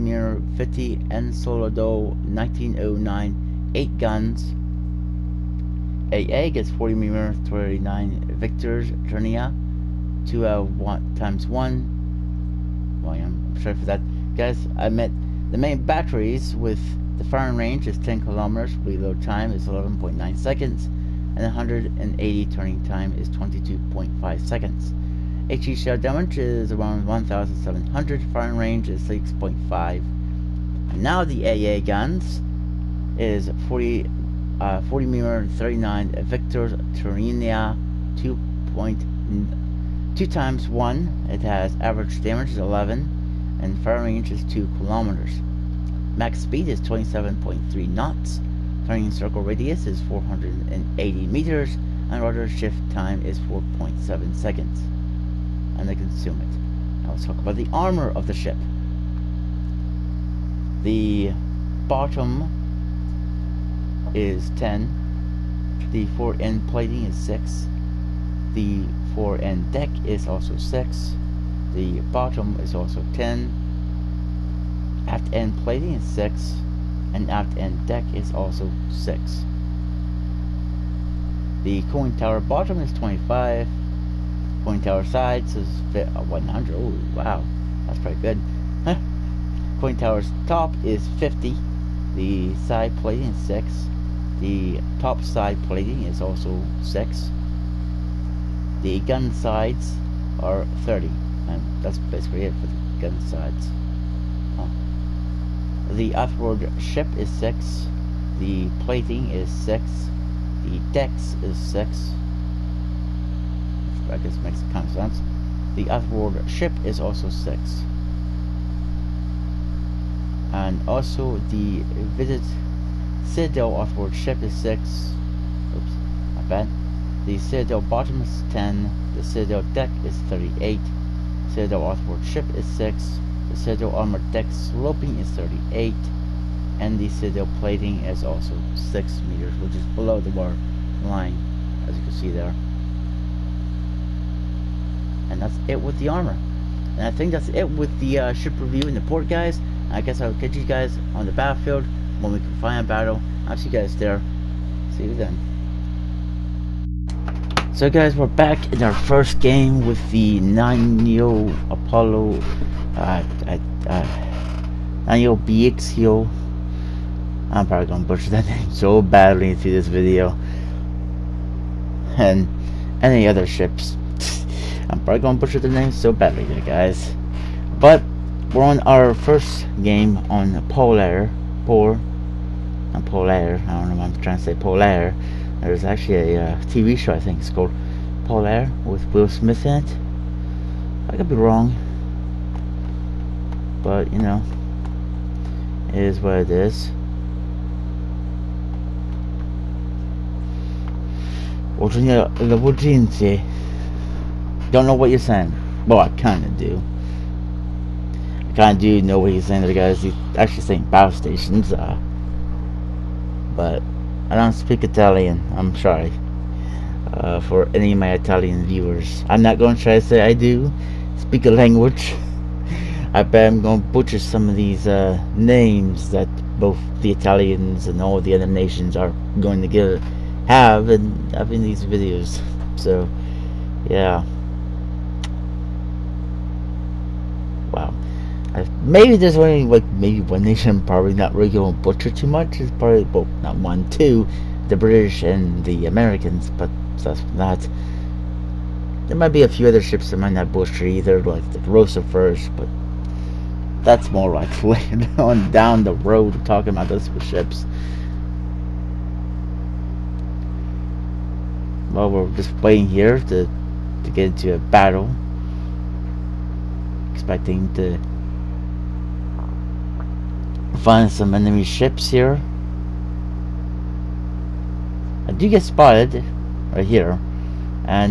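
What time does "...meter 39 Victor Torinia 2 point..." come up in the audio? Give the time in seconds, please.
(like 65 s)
35 s.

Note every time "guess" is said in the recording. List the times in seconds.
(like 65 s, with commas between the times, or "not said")
114 s, 150 s.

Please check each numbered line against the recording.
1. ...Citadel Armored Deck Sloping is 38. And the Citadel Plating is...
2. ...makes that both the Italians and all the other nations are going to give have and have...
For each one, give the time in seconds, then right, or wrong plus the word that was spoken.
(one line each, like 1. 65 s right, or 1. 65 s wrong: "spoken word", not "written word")
1. 133 s right
2. 225 s wrong: "names", not "makes".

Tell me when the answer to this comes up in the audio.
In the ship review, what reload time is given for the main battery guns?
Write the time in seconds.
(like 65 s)
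19 s.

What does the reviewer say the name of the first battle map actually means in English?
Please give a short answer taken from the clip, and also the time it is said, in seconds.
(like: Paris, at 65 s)
power stations, at 210 s.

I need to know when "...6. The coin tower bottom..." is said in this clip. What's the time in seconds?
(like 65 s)
78 s.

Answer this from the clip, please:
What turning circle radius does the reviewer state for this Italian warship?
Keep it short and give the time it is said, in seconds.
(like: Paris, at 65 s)
480 meters, at 50 s.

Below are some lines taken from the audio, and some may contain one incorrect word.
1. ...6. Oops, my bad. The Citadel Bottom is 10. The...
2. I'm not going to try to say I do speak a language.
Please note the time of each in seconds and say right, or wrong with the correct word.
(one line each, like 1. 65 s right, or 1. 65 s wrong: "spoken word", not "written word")
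1. 124 s right
2. 219 s right.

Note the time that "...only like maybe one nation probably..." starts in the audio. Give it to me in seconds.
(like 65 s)
239 s.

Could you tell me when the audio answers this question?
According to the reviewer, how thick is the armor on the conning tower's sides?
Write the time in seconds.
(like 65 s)
86 s.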